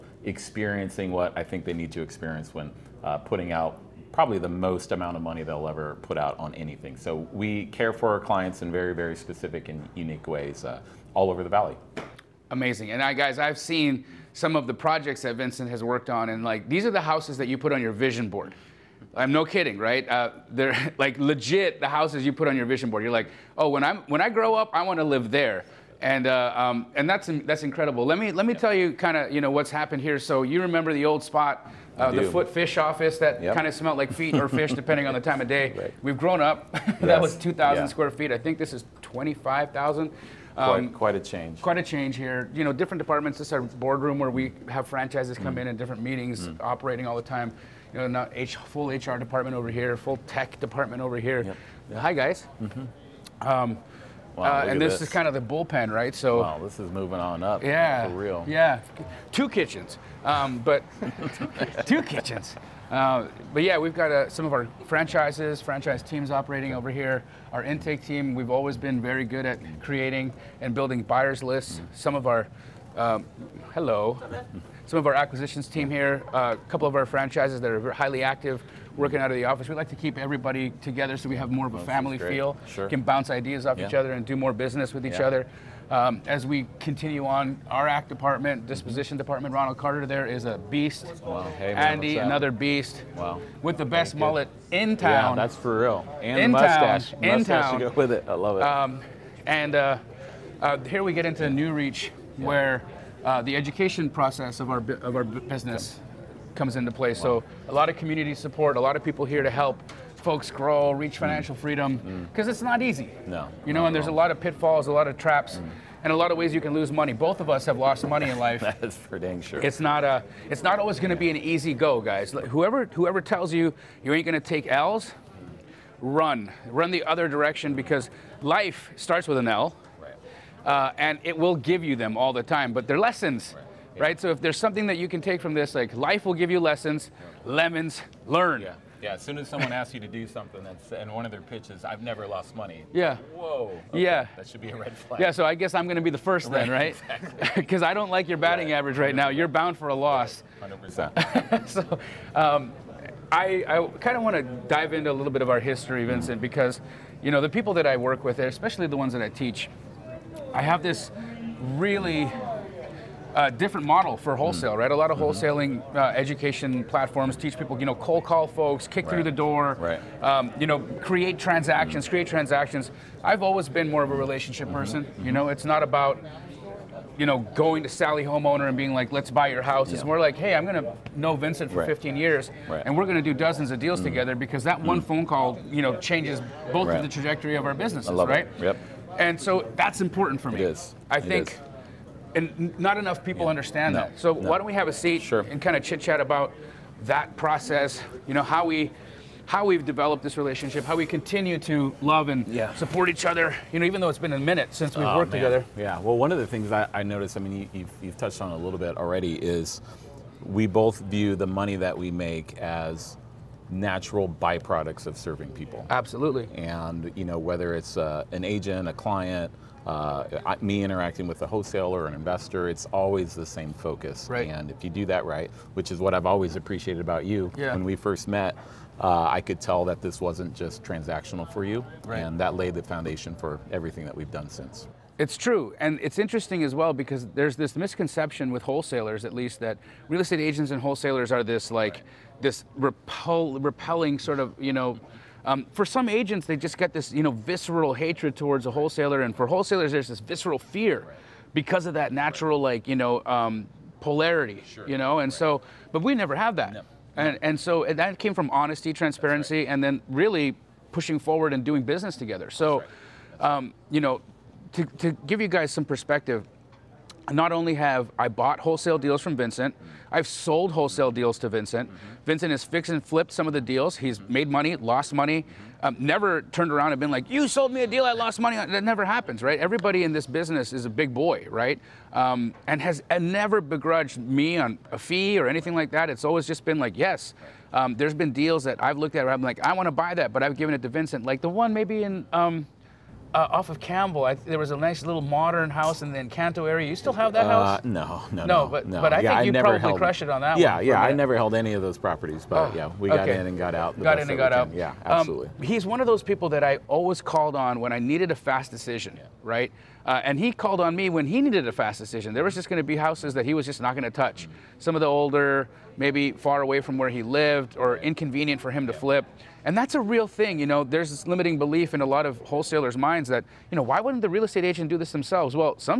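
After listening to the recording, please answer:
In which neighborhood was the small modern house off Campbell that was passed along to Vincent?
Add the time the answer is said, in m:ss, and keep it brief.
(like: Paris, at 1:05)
Encanto, at 4:56.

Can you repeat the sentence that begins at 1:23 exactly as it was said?
each other and do more business with each yeah.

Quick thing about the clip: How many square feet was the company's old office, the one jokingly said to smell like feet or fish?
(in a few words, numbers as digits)
2,000.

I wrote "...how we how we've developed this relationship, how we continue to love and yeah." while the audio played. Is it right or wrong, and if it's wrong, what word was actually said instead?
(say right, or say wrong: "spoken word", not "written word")
right.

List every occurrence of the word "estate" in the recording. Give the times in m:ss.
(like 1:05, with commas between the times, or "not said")
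4:00, 5:24.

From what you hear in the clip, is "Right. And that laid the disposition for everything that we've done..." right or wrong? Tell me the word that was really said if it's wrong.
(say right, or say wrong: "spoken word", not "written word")
wrong: "foundation", not "disposition".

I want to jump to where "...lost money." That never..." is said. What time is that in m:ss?
4:38.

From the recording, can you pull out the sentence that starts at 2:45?
wholesaling uh, education platforms teach people, you know, cold call folks, kick right.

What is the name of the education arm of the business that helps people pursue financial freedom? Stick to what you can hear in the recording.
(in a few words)
New Reach.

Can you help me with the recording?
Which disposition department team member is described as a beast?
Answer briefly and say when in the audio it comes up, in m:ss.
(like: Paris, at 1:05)
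Ronald Carter, at 1:29.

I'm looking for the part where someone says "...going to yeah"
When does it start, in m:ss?
2:00.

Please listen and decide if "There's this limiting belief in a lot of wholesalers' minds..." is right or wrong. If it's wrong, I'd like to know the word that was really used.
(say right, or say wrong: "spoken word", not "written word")
right.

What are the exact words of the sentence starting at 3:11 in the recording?
I think and not enough people yeah.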